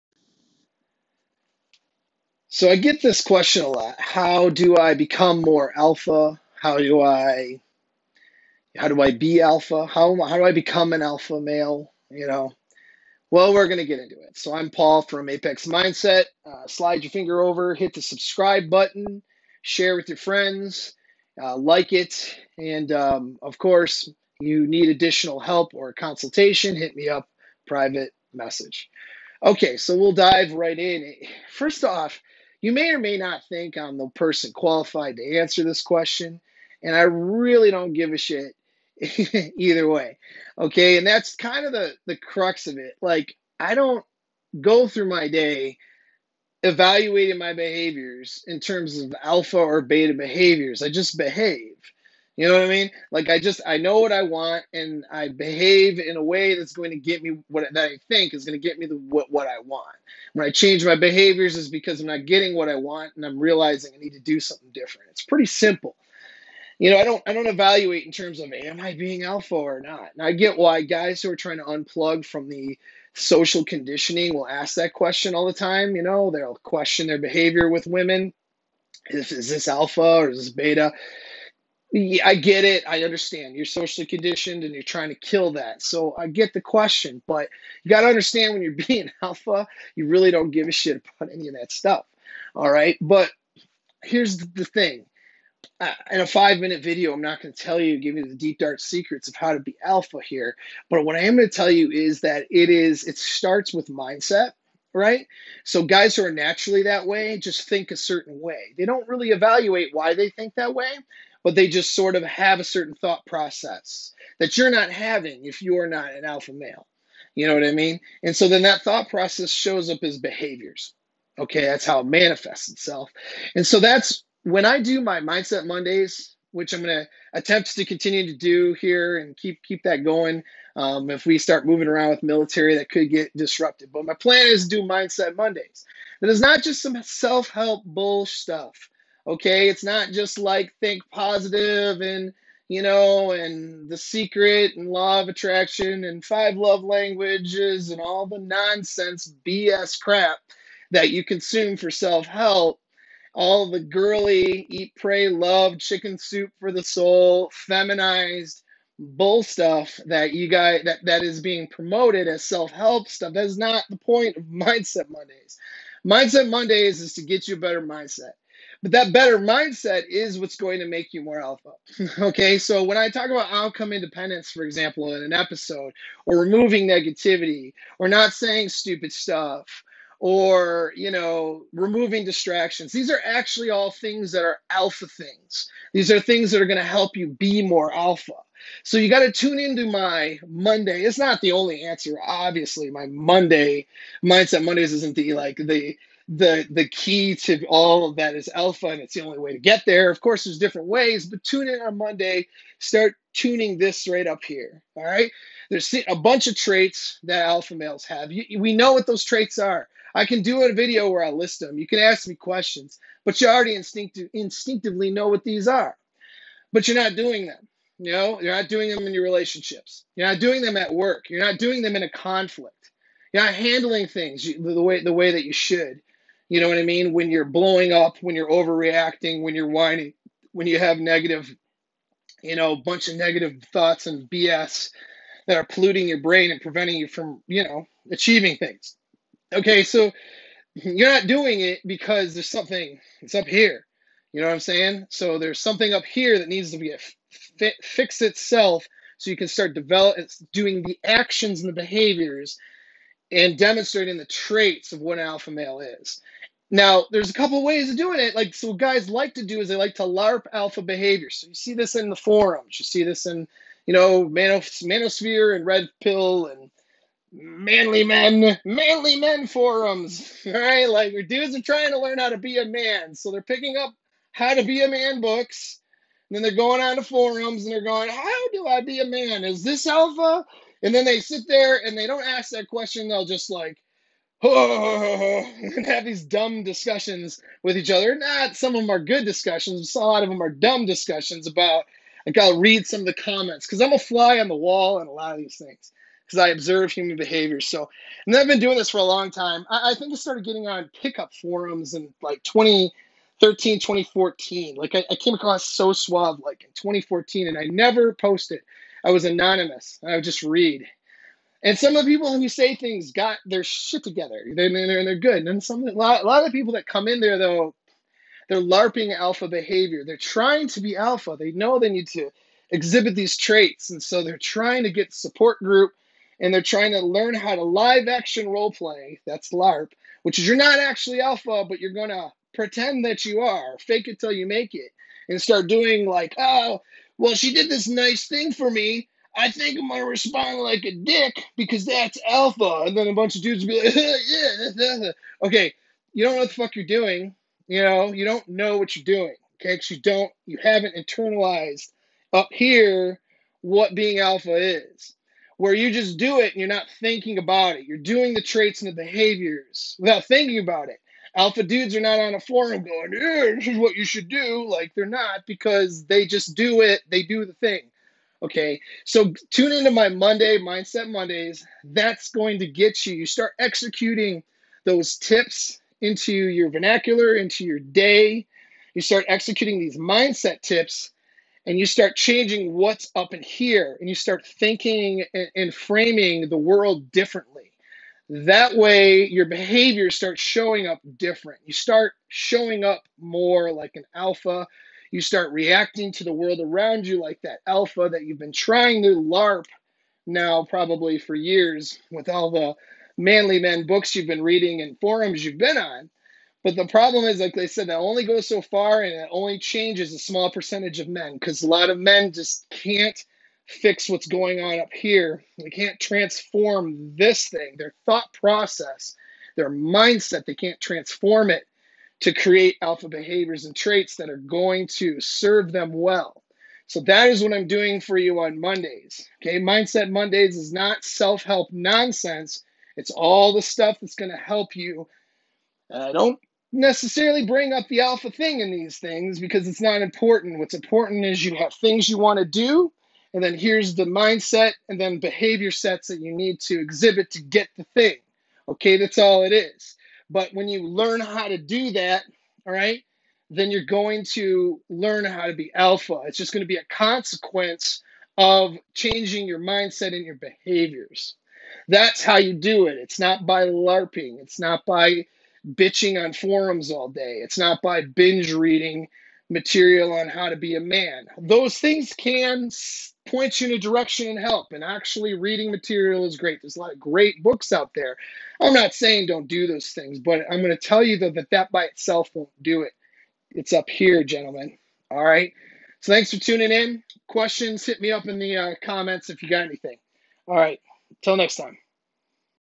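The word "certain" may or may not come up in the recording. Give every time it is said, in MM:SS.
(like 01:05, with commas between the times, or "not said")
01:47, 01:52.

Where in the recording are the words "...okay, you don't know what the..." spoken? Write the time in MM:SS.
05:45.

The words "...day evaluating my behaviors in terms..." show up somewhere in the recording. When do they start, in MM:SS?
00:45.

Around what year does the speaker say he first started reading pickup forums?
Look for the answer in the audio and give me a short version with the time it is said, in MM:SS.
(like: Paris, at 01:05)
2013, at 05:02.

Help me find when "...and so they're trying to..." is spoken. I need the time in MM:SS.
05:23.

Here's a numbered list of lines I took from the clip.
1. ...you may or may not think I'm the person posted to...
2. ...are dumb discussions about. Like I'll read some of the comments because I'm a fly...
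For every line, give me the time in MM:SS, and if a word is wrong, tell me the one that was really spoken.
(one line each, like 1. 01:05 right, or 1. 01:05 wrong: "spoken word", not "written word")
1. 00:32 wrong: "qualified", not "posted"
2. 04:50 right.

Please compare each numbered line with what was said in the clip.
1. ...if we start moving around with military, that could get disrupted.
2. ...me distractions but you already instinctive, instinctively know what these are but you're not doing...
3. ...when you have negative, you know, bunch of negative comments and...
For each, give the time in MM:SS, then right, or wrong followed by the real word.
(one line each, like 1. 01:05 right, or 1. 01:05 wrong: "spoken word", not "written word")
1. 02:11 right
2. 03:32 wrong: "questions", not "distractions"
3. 03:50 wrong: "thoughts", not "comments".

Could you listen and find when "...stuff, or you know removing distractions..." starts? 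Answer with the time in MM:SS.
02:59.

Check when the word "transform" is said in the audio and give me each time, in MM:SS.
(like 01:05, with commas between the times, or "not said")
06:55, 07:00.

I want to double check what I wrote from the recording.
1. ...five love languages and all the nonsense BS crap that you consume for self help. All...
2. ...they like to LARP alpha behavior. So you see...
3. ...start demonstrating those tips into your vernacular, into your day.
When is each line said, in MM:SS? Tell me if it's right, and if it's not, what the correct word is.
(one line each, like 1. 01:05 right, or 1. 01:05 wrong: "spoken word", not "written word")
1. 02:26 right
2. 04:19 right
3. 06:13 wrong: "executing", not "demonstrating".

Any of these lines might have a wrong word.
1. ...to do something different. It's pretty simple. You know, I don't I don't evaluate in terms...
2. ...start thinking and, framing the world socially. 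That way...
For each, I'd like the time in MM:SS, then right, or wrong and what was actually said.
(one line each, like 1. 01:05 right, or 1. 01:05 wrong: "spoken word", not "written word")
1. 01:04 right
2. 06:24 wrong: "differently", not "socially".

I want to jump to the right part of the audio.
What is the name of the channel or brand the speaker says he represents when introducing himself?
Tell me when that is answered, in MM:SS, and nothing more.
00:15.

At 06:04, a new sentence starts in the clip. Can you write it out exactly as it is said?
Like they're not because they just do it.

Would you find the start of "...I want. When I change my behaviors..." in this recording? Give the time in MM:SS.
00:59.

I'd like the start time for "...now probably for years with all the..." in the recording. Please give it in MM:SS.
06:40.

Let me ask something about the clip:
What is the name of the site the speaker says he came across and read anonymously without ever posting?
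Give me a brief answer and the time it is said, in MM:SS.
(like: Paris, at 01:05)
So Suave, at 05:05.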